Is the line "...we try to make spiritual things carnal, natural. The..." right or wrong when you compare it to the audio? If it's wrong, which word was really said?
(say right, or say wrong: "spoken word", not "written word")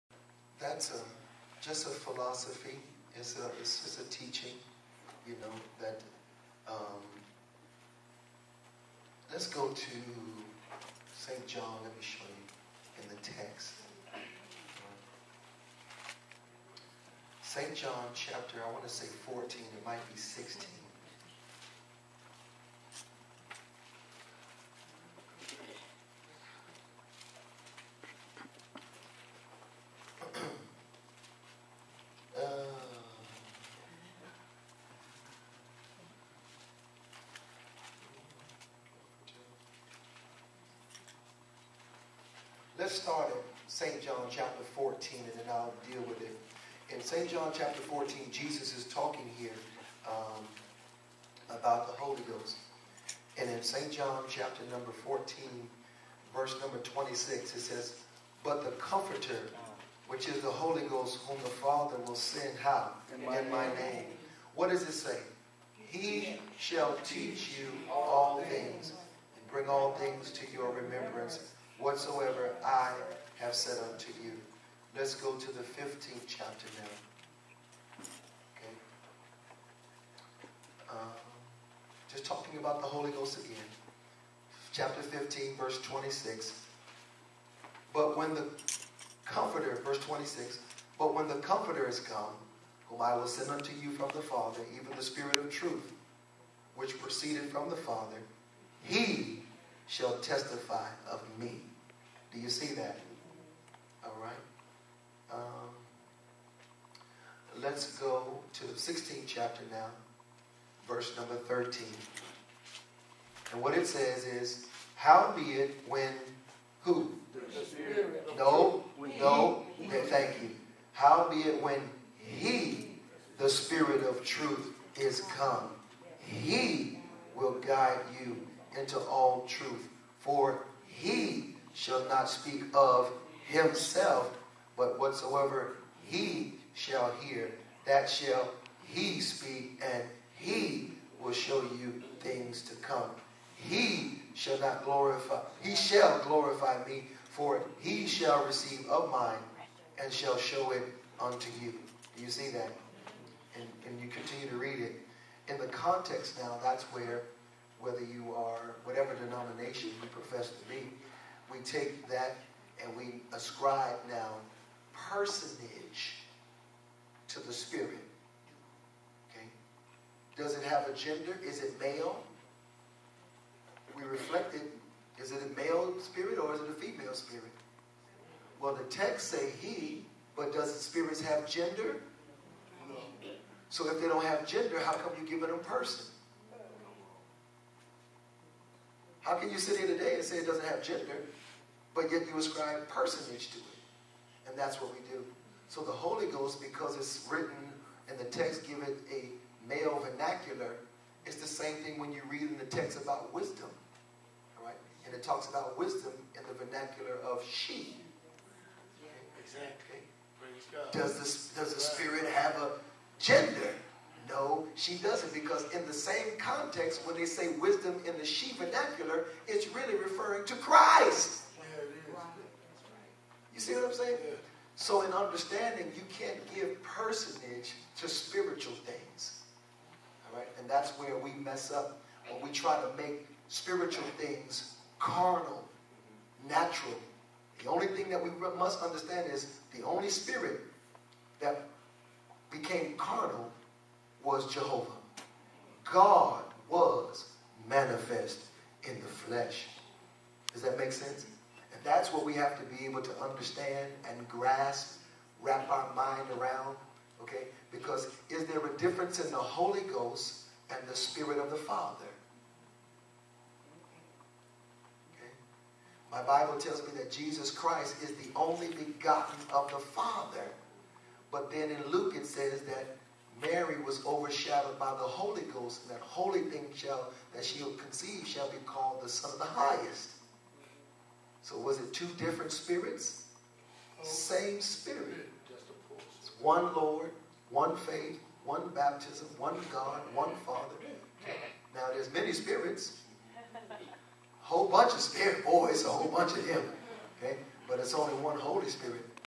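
right.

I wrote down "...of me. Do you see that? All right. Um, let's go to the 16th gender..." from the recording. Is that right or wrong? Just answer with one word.
wrong.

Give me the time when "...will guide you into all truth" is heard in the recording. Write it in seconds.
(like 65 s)
127 s.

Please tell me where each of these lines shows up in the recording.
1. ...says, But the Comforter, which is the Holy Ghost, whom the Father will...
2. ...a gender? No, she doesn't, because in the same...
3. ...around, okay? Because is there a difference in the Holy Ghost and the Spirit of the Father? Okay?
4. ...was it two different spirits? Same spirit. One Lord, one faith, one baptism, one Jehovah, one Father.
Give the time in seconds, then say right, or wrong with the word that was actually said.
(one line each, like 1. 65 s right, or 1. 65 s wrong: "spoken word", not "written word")
1. 57 s right
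2. 212 s right
3. 256 s right
4. 281 s wrong: "God", not "Jehovah".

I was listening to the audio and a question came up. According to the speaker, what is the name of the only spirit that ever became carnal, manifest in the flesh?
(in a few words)
Jehovah.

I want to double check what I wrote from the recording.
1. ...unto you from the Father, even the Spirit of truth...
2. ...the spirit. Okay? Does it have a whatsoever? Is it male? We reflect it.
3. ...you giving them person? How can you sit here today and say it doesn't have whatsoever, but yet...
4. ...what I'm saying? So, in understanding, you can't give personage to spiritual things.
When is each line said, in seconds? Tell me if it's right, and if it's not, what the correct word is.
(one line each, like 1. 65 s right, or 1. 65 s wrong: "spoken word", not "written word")
1. 93 s right
2. 167 s wrong: "gender", not "whatsoever"
3. 185 s wrong: "gender", not "whatsoever"
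4. 223 s right.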